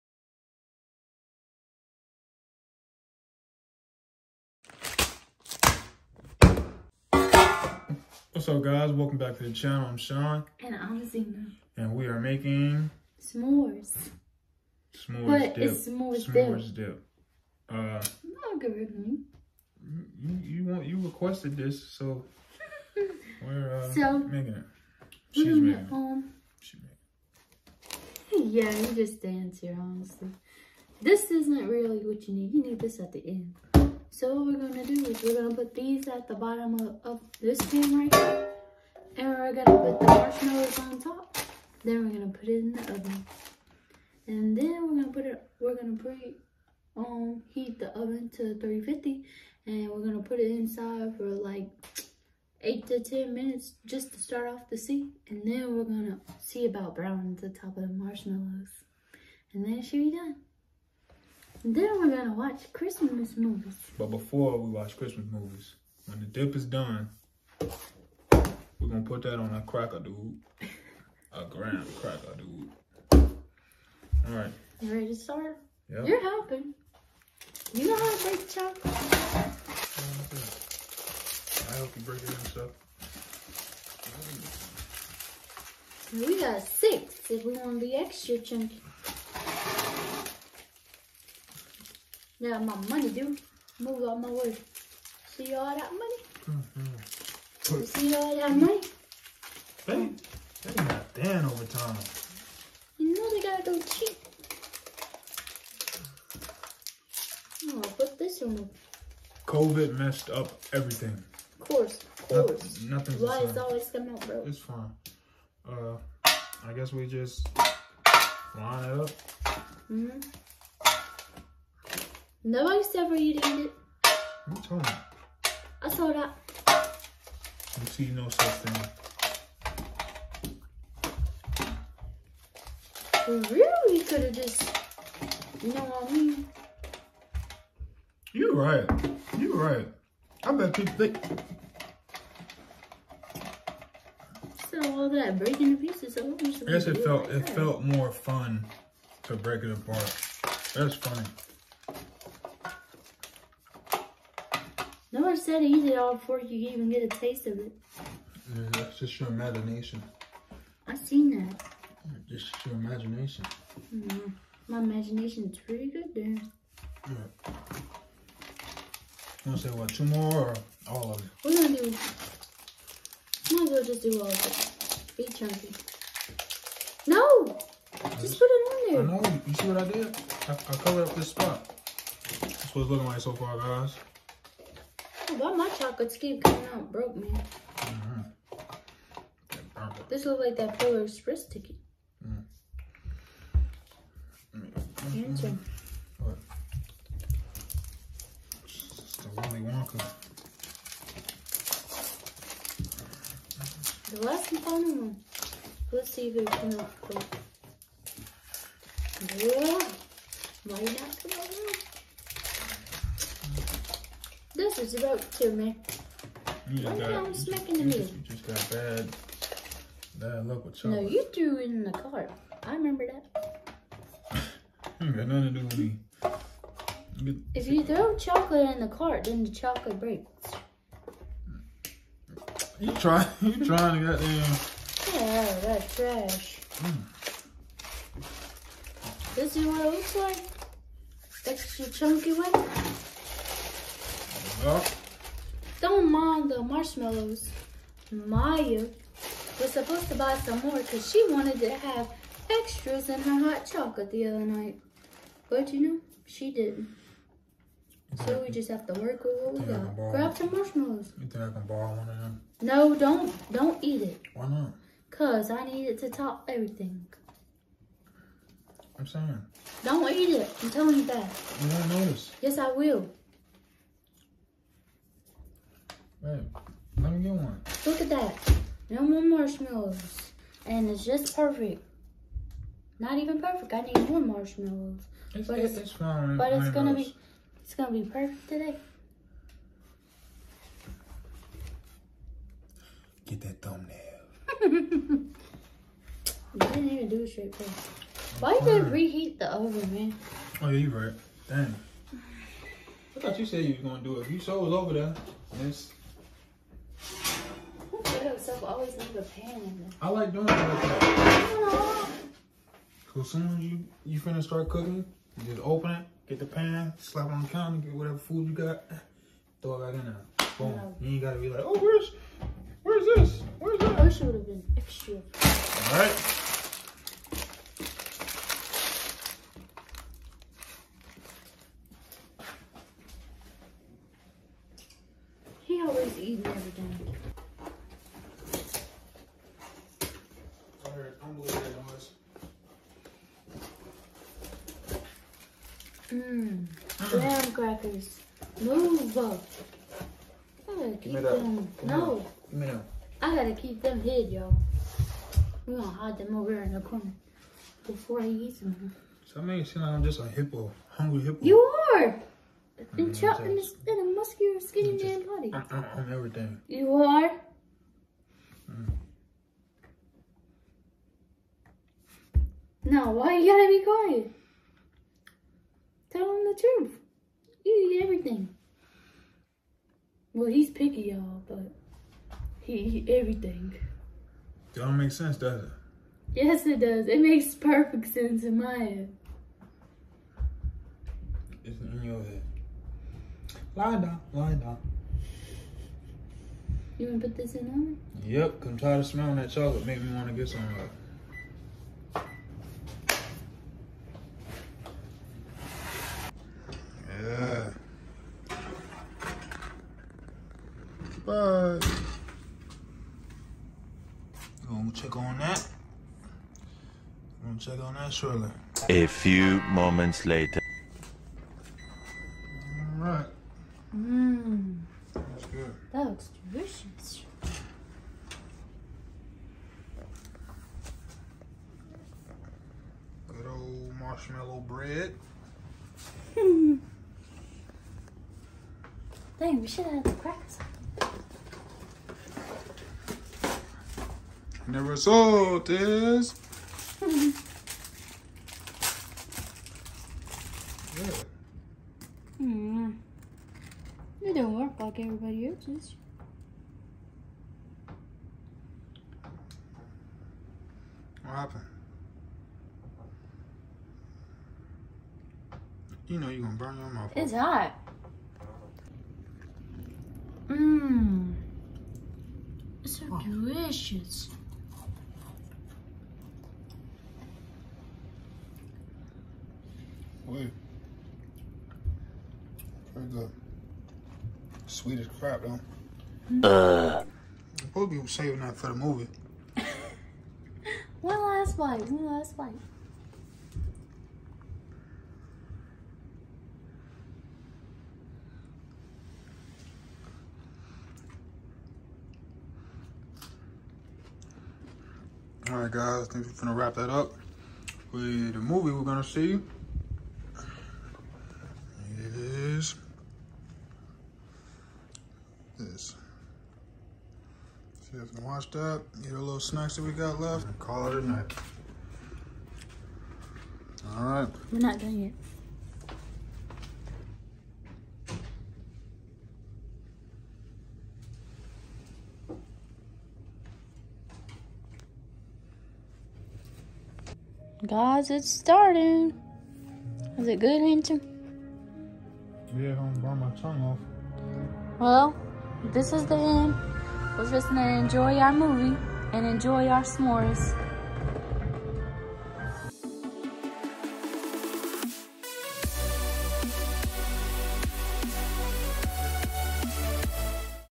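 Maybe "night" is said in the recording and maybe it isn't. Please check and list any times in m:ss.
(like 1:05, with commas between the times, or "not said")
4:14, 8:41.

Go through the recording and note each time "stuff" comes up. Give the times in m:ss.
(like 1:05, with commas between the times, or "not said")
1:22.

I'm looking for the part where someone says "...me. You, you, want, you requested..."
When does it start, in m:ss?
0:18.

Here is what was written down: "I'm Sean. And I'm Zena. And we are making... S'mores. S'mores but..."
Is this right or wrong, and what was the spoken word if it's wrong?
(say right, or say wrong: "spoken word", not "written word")
right.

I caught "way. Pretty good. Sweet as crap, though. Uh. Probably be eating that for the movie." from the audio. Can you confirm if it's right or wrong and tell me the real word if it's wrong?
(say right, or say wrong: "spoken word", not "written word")
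wrong: "saving", not "eating".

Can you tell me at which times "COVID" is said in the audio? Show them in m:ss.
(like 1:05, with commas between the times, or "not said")
1:49.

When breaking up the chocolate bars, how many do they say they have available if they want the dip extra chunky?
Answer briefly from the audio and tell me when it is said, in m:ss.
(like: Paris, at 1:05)
6, at 1:26.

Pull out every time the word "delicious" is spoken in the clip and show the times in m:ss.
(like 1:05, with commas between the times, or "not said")
7:06, 7:53.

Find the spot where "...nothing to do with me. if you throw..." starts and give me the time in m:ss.
3:45.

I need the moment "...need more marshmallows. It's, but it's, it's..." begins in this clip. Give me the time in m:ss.
4:43.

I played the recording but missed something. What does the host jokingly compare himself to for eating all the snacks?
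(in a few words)
hungry hippo.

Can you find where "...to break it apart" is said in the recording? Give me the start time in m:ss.
2:29.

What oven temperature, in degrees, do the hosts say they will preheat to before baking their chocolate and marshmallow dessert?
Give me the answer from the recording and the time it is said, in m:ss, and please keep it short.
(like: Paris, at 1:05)
350, at 0:48.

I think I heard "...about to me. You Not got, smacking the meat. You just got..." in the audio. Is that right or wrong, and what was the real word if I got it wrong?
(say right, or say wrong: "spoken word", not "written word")
wrong: "Why", not "Not".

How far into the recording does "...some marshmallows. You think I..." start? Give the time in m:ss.
4:20.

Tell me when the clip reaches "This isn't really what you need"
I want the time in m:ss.
0:30.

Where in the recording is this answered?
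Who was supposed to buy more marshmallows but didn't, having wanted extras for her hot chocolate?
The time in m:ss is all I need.
4:08.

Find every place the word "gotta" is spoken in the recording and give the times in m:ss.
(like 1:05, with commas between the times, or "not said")
1:43, 5:21, 5:53, 6:13.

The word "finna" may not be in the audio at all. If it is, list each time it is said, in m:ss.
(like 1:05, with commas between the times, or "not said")
5:14.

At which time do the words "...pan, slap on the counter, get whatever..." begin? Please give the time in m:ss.
5:16.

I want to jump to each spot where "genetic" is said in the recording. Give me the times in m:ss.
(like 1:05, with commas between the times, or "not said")
not said.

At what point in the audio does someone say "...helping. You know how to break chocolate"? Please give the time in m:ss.
1:16.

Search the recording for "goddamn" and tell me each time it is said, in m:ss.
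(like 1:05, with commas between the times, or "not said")
3:54.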